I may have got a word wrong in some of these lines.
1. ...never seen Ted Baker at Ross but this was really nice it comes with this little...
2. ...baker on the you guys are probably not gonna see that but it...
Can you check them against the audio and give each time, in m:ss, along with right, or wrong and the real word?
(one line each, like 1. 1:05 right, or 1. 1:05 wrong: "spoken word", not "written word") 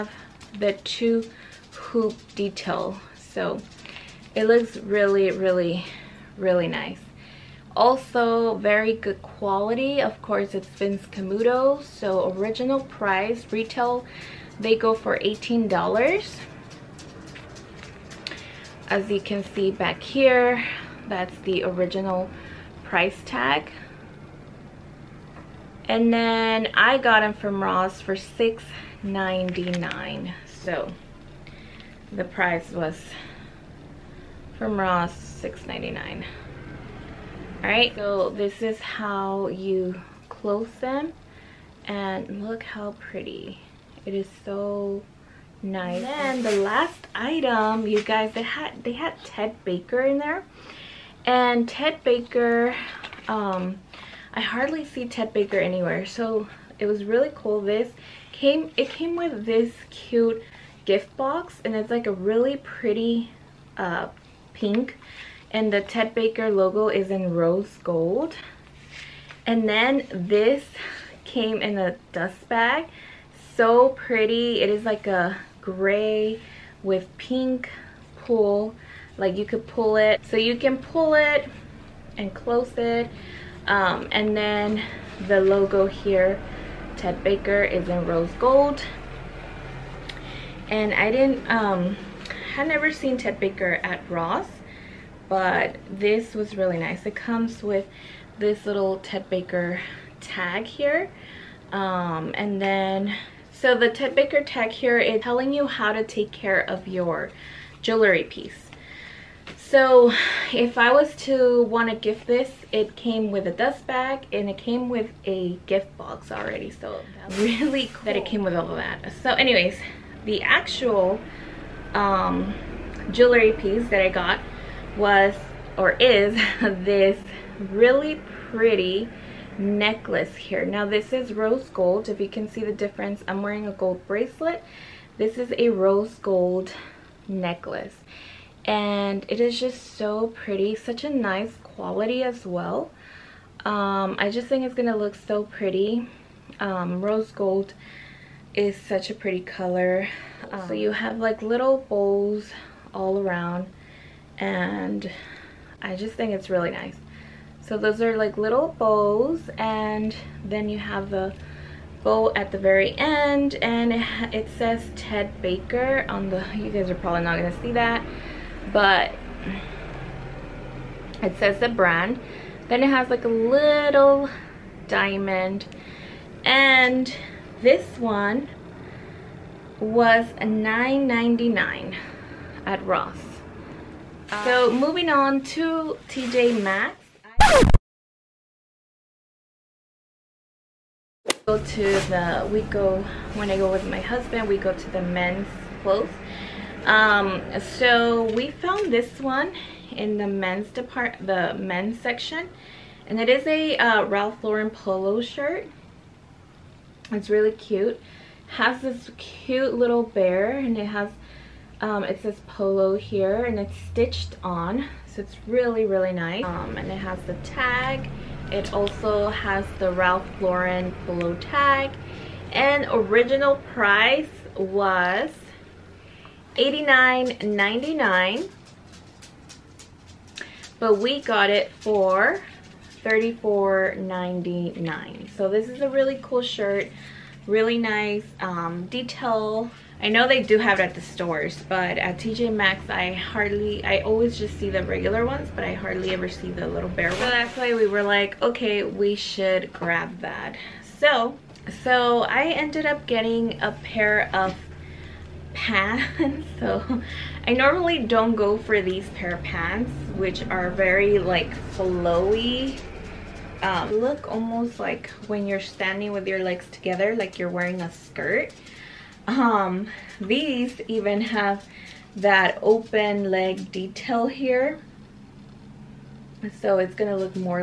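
1. 1:32 right
2. 2:45 right.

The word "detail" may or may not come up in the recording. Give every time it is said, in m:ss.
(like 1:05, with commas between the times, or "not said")
0:02, 3:58, 4:33.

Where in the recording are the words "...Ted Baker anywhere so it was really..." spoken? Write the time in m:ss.
0:55.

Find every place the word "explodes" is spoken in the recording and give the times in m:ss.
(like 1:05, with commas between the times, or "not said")
not said.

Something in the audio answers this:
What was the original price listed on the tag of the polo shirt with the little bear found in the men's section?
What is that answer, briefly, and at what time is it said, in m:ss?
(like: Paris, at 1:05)
$89.99, at 3:46.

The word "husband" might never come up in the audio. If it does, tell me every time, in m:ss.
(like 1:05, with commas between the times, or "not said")
3:13.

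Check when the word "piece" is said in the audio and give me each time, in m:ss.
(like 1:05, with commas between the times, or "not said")
1:48, 2:03.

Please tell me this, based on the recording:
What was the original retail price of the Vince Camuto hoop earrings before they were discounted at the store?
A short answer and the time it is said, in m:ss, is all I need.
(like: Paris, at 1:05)
$18, at 0:15.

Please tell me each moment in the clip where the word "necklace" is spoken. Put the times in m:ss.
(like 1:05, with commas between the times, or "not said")
2:09, 2:17.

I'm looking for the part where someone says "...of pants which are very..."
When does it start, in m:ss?
4:19.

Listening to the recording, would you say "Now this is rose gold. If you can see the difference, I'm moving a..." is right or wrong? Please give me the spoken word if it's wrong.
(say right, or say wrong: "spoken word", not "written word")
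wrong: "wearing", not "moving".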